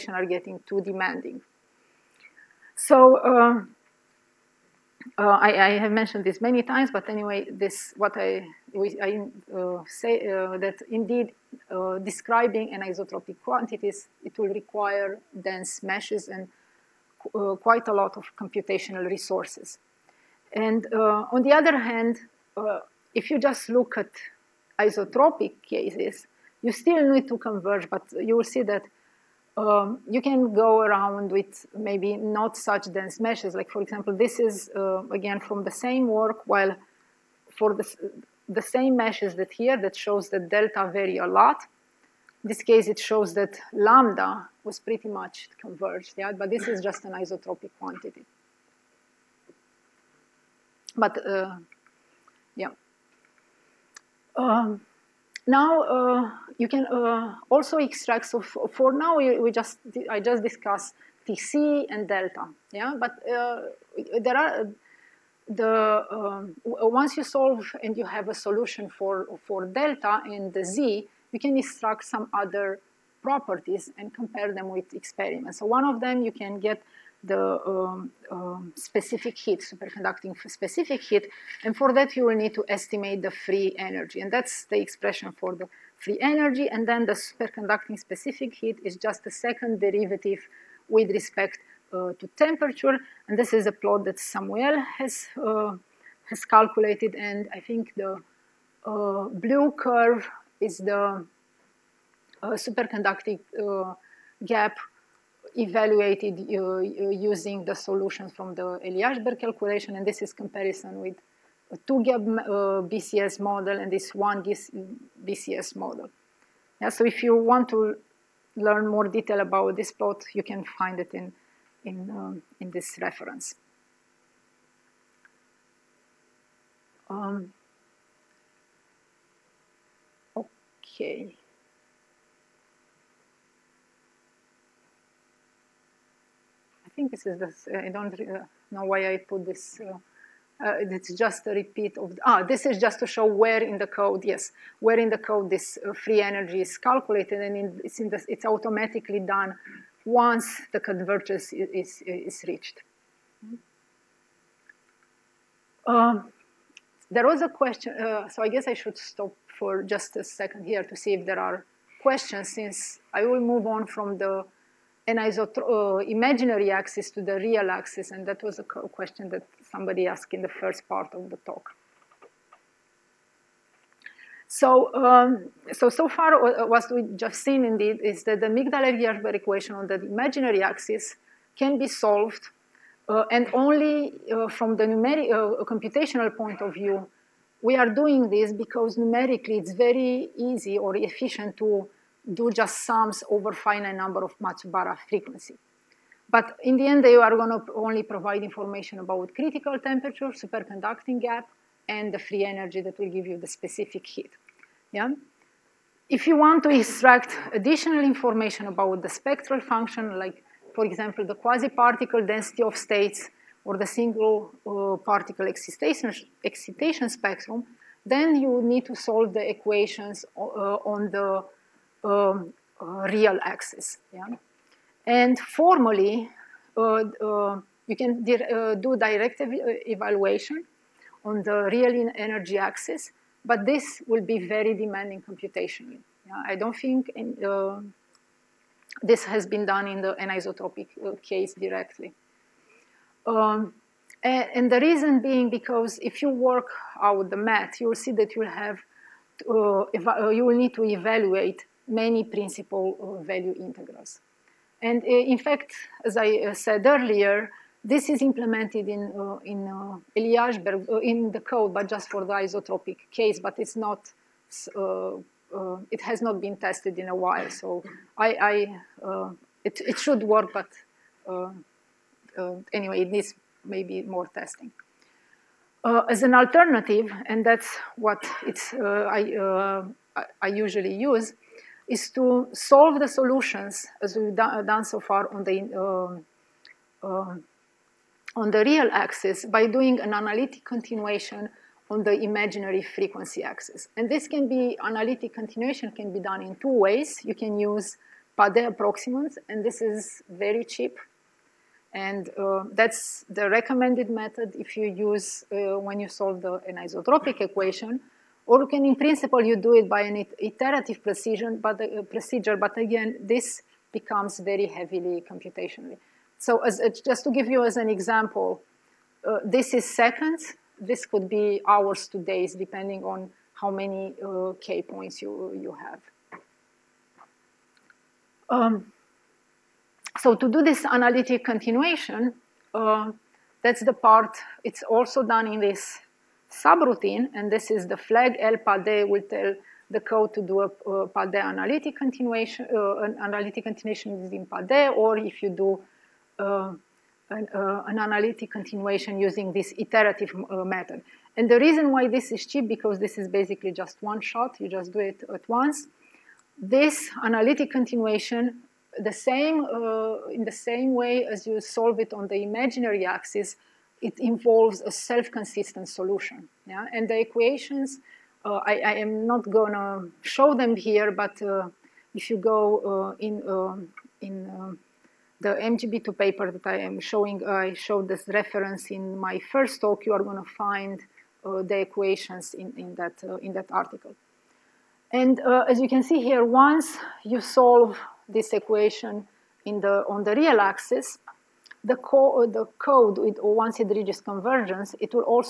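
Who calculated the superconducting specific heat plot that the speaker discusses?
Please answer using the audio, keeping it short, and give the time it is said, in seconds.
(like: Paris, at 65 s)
Samuel, at 94 s.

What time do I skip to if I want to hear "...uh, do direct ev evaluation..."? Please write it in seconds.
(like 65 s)
228 s.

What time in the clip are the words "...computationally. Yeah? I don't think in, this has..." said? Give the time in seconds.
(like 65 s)
235 s.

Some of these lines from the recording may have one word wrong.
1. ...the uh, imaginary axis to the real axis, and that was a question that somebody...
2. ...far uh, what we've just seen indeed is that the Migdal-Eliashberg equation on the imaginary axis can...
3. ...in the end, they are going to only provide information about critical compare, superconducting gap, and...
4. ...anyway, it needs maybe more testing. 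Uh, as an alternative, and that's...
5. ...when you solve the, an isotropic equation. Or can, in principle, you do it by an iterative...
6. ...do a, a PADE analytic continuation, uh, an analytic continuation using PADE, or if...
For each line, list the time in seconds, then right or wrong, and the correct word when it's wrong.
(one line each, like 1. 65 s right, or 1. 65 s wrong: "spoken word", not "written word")
1. 164 s right
2. 176 s right
3. 196 s wrong: "temperature", not "compare"
4. 272 s right
5. 305 s right
6. 340 s right.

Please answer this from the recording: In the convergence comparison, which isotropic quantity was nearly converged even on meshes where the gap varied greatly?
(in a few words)
lambda.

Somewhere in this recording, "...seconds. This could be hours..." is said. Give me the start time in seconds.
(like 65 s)
319 s.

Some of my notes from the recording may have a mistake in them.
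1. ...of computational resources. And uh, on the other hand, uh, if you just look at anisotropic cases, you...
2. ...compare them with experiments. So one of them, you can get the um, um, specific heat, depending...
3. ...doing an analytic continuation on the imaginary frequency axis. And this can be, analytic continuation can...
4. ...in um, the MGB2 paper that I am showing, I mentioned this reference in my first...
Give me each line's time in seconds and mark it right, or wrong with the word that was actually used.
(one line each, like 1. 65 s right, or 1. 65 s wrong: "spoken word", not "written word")
1. 18 s wrong: "isotropic", not "anisotropic"
2. 74 s wrong: "superconducting", not "depending"
3. 289 s right
4. 374 s wrong: "showed", not "mentioned".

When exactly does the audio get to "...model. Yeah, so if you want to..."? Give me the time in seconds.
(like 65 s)
115 s.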